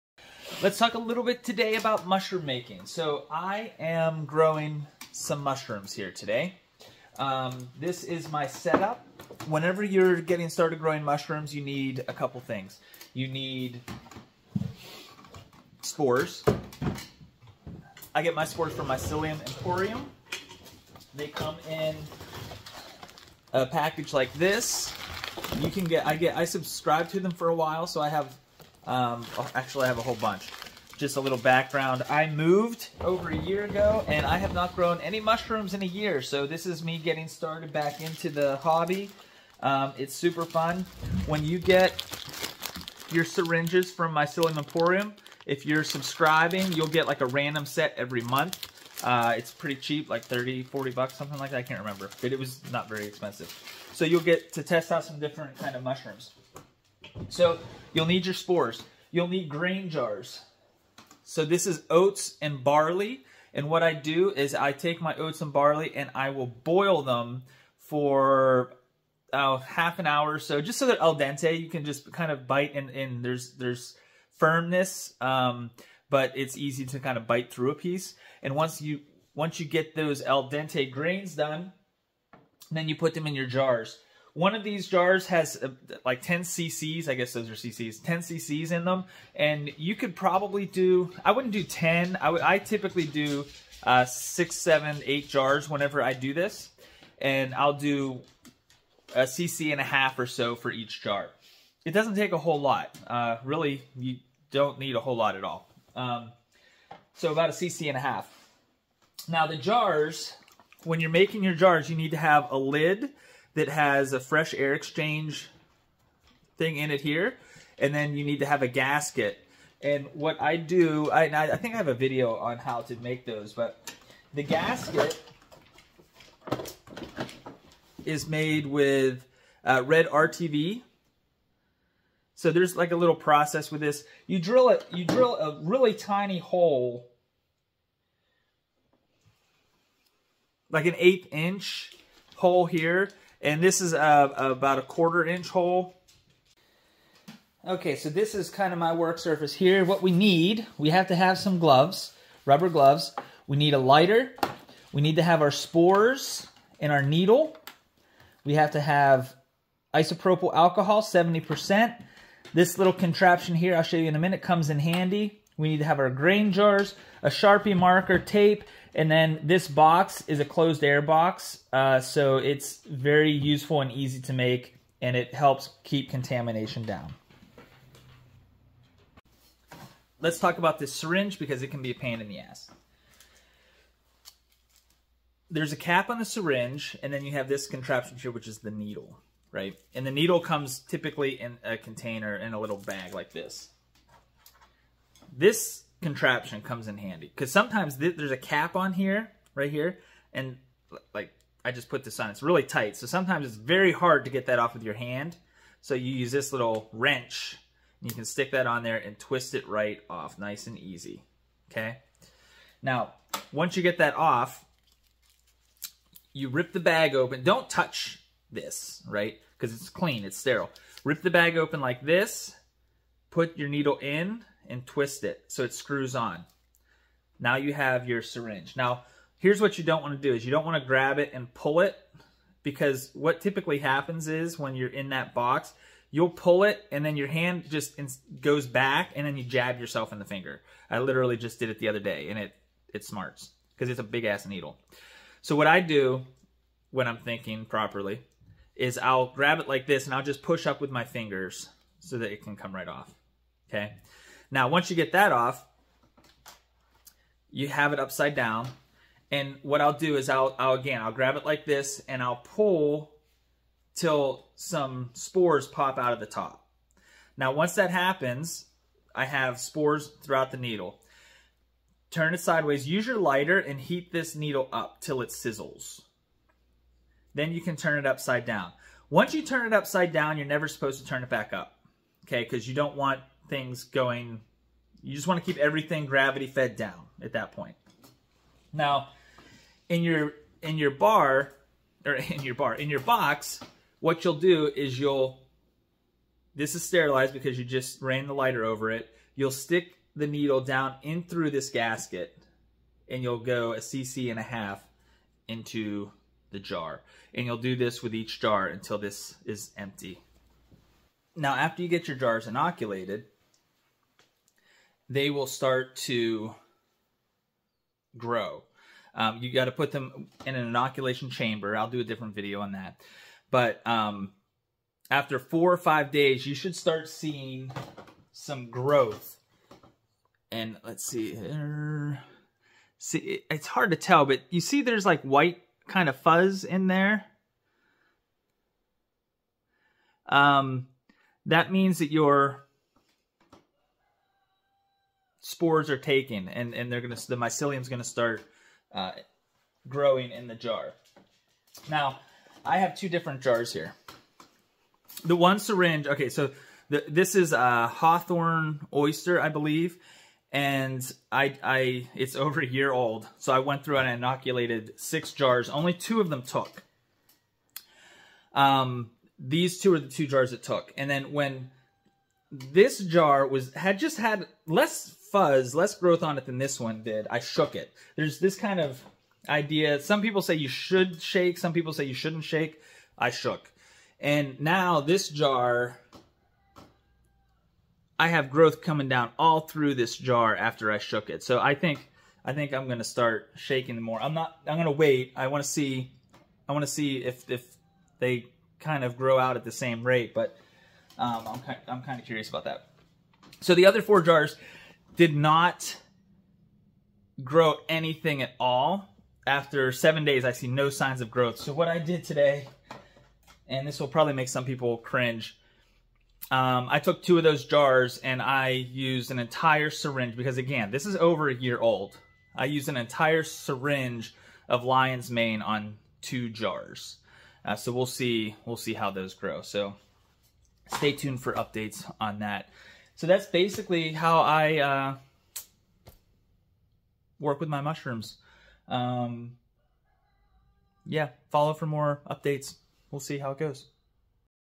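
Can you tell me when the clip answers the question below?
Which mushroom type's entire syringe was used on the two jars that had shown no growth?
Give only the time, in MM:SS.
07:04.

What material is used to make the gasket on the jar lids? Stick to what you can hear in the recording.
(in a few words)
Red RTV.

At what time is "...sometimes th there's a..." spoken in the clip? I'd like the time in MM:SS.
03:17.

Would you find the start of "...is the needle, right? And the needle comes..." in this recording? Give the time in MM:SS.
03:08.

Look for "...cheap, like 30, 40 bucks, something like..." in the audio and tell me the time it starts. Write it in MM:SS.
00:49.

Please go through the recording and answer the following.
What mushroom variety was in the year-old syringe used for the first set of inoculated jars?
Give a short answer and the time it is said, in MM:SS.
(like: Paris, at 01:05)
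Hawthorn oyster, at 05:57.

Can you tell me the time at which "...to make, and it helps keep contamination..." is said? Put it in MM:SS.
02:54.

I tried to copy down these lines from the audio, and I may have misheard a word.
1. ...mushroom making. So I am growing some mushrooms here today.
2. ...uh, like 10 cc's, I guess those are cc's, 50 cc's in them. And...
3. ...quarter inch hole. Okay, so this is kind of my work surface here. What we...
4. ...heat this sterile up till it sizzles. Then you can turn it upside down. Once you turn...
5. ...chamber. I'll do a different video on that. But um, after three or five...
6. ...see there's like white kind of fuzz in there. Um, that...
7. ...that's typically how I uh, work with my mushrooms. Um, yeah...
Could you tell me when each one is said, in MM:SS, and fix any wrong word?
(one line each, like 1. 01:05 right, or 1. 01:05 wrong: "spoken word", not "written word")
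1. 00:02 right
2. 01:25 wrong: "10", not "50"
3. 02:24 right
4. 04:33 wrong: "needle", not "sterile"
5. 05:21 wrong: "four", not "three"
6. 05:34 right
7. 07:13 wrong: "basically", not "typically".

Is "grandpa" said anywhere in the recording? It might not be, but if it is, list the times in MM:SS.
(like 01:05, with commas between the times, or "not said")
not said.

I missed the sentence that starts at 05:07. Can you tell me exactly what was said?
And you'll do this with each jar until this is empty.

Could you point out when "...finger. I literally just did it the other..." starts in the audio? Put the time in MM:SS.
04:00.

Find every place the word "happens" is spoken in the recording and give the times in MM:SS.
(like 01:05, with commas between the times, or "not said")
03:53, 04:27.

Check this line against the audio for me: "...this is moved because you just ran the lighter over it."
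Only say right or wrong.
wrong.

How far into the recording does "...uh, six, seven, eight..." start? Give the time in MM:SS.
01:33.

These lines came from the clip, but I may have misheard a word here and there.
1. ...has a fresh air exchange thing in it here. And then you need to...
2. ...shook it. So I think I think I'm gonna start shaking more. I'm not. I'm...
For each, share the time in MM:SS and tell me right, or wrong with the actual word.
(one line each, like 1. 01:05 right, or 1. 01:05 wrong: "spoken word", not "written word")
1. 01:53 right
2. 06:30 right.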